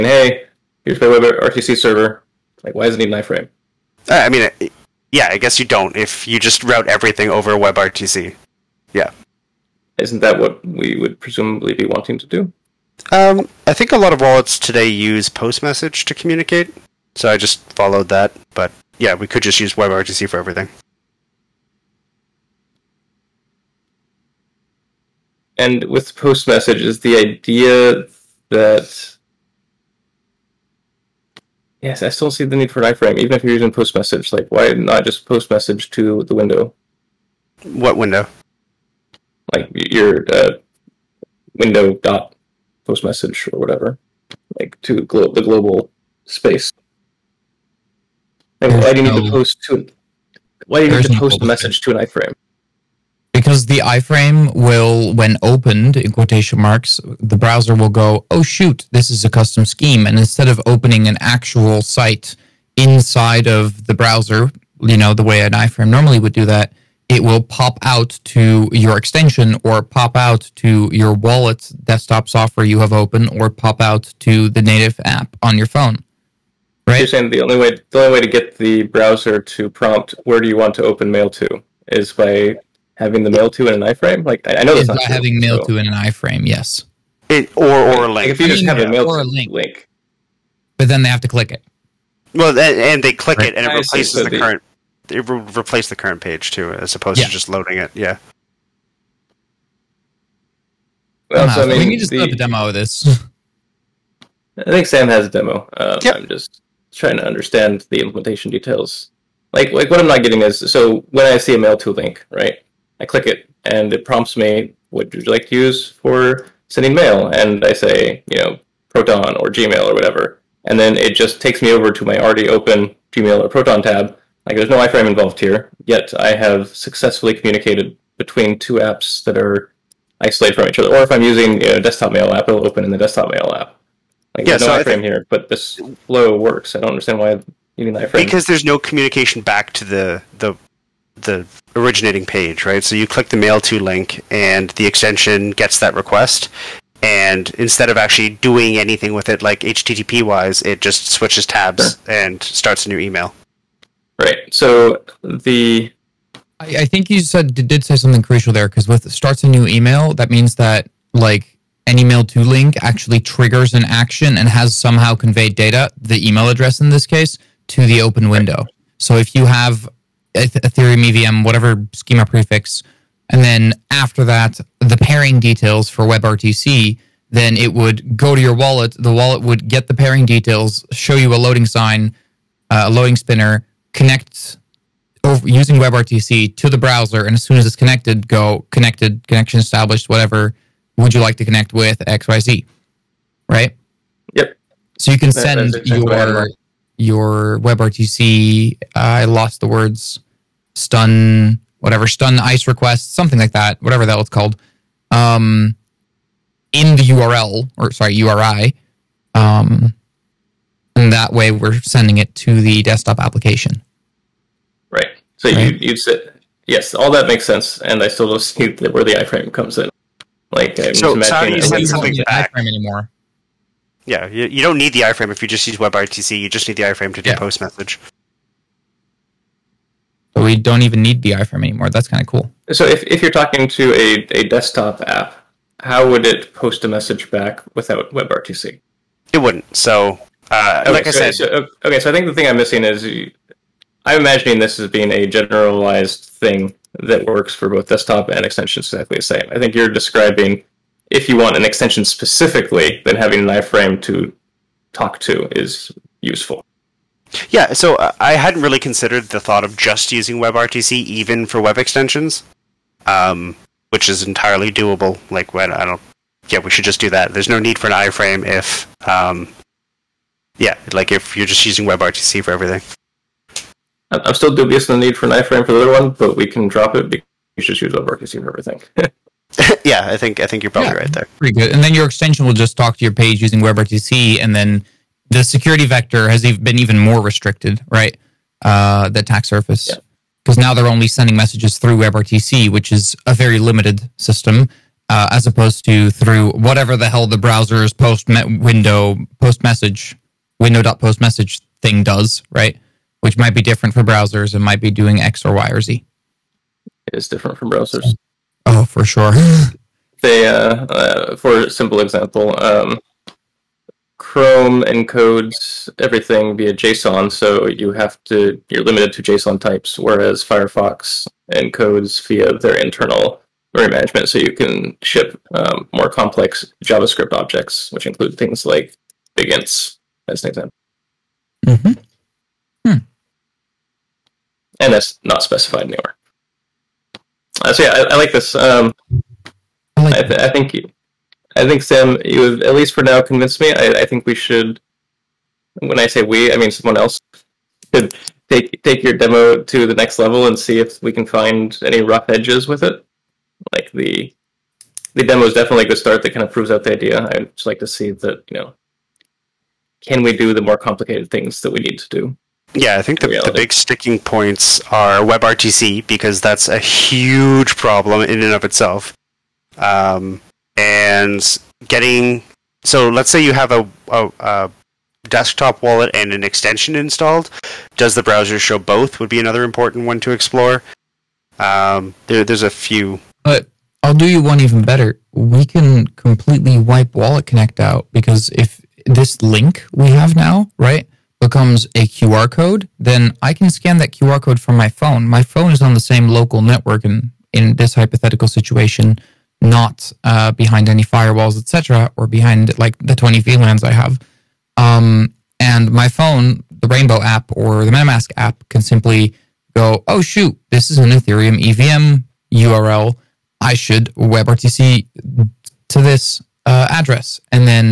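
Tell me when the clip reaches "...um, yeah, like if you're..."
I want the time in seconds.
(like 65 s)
269 s.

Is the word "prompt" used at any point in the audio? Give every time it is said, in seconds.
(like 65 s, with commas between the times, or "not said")
79 s, 114 s.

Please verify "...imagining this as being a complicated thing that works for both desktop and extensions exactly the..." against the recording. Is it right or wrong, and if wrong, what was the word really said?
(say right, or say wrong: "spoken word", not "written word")
wrong: "generalized", not "complicated".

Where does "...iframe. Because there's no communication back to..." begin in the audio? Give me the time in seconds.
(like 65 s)
137 s.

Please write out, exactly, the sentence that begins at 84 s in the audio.
Like I, know that's not true, having mail so.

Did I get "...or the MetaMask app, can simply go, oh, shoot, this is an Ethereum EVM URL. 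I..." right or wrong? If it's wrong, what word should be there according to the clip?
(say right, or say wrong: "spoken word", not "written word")
right.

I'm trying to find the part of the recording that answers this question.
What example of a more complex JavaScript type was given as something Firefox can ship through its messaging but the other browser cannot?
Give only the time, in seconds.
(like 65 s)
329 s.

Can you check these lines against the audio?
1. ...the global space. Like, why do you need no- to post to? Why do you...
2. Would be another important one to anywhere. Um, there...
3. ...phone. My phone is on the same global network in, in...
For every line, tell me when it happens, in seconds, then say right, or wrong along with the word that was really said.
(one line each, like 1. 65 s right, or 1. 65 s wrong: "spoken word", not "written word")
1. 45 s right
2. 379 s wrong: "explore", not "anywhere"
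3. 394 s wrong: "local", not "global".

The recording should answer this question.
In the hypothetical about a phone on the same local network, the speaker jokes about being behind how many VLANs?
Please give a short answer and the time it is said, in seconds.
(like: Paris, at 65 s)
20, at 403 s.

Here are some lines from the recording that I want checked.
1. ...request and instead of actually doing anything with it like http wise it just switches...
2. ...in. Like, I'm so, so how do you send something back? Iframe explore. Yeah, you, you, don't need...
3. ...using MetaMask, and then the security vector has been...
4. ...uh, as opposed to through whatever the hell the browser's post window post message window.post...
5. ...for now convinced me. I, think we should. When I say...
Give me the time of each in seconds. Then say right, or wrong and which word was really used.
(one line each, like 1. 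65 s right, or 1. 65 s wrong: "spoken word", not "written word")
1. 145 s right
2. 219 s wrong: "anymore", not "explore"
3. 283 s wrong: "WebRTC", not "MetaMask"
4. 295 s right
5. 342 s right.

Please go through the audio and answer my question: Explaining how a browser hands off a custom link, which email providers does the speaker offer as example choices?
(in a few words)
Proton or Gmail.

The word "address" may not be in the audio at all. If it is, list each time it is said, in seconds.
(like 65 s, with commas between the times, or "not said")
166 s, 416 s.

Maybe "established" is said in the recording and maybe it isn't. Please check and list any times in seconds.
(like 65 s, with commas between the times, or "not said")
189 s.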